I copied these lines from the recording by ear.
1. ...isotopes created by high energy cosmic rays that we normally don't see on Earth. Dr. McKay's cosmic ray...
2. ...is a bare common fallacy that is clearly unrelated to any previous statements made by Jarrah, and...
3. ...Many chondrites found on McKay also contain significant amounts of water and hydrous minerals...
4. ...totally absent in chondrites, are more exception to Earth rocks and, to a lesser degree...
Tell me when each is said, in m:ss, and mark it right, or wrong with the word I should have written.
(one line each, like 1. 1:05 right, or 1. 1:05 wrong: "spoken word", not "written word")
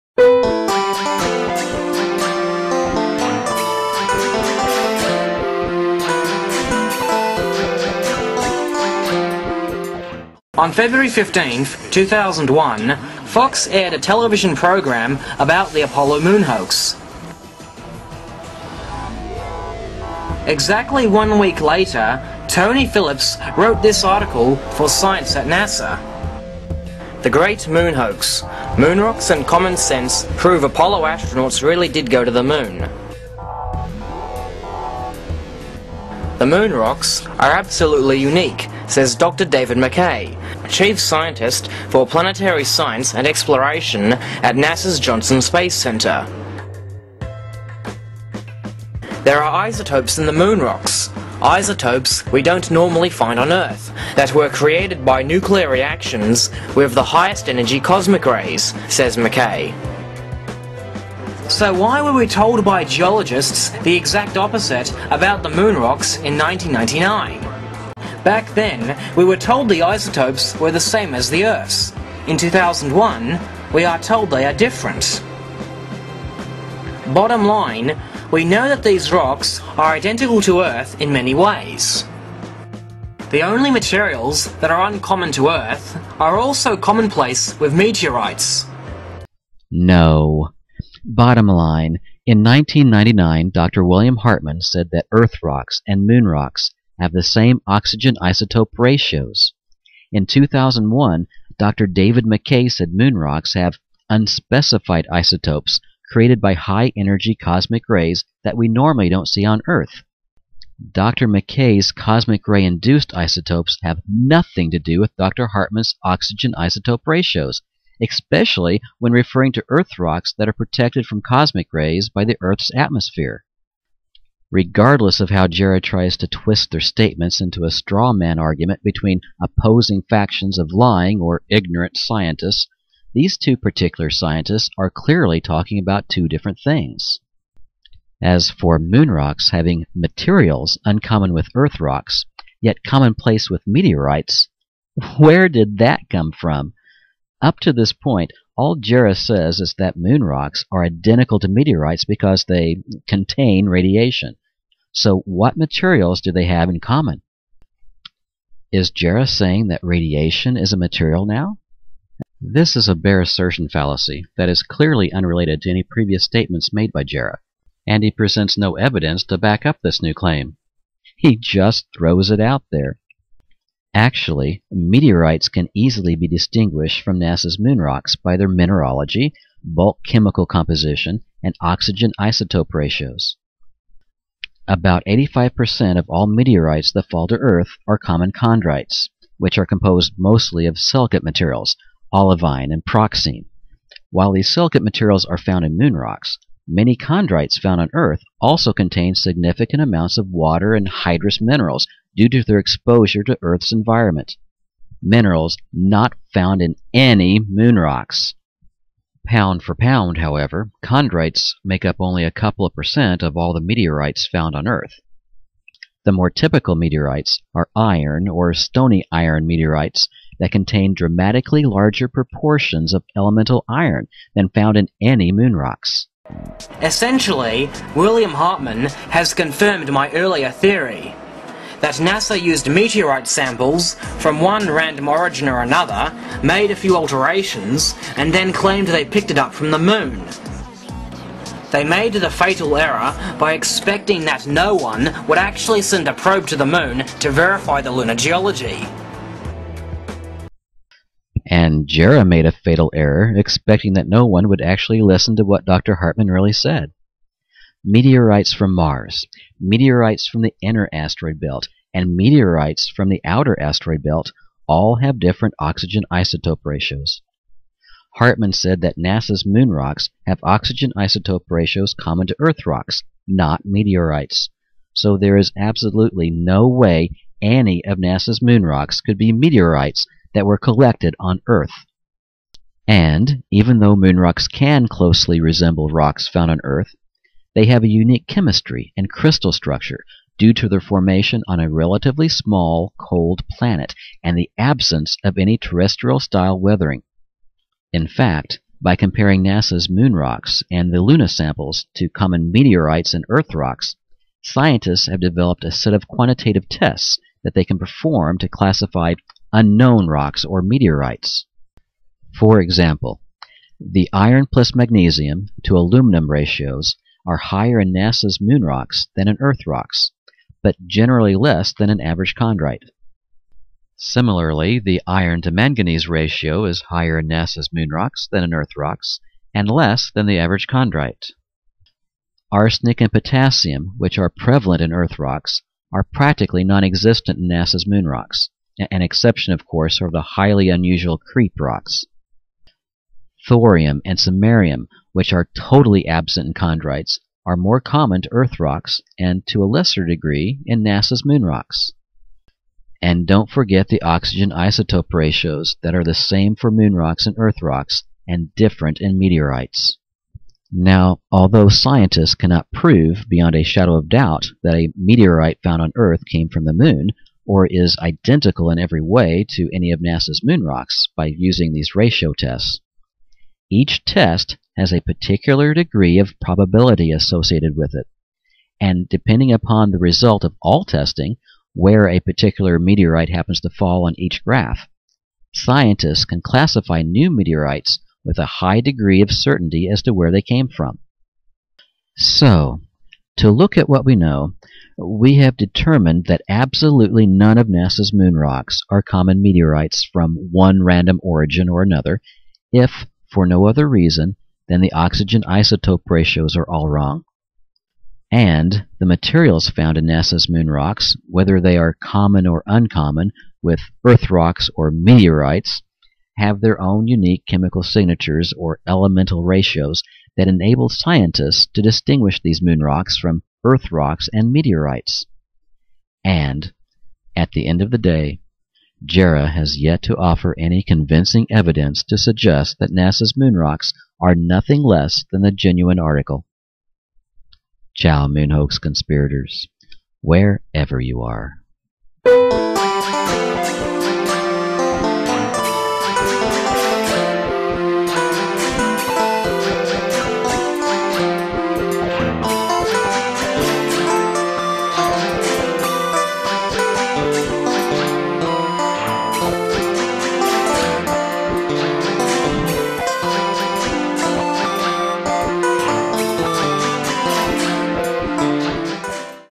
1. 1:45 right
2. 2:42 wrong: "assertion", not "common"
3. 3:16 wrong: "Earth", not "McKay"
4. 5:45 wrong: "common", not "exception".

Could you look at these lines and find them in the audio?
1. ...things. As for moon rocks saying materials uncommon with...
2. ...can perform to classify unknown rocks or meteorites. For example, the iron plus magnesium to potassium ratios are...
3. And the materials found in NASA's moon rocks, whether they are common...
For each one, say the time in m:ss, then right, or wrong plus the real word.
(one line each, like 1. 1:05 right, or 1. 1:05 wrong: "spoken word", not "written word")
1. 2:16 wrong: "having", not "saying"
2. 5:07 wrong: "aluminum", not "potassium"
3. 6:48 right.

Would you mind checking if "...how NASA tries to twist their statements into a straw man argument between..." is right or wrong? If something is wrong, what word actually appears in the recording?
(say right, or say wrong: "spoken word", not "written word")
wrong: "Jarrah", not "NASA".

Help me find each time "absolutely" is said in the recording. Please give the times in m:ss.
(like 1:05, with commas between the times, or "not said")
0:37, 4:35, 6:36.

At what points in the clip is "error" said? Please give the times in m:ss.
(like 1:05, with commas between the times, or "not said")
4:02, 4:12.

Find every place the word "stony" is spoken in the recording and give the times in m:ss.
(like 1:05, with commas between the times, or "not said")
3:38.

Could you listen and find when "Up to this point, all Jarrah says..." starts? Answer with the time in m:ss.
2:27.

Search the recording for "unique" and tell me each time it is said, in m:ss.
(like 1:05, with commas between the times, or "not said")
0:38, 4:47, 6:57.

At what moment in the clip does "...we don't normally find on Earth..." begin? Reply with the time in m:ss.
0:52.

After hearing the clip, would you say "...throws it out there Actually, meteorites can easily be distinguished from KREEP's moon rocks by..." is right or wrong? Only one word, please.
wrong.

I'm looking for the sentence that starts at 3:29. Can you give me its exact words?
Pound for pound, however, chondrites make up only a couple of percent of all the meteorites found on Earth.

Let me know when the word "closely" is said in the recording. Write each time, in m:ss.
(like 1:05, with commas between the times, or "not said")
4:44.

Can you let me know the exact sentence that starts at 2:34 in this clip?
So, what materials do they have in common?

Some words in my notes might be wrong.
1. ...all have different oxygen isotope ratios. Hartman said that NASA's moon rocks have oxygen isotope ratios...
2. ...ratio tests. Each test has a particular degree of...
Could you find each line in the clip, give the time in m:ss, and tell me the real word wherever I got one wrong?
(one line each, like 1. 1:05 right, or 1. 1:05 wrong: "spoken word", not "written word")
1. 4:24 right
2. 6:11 right.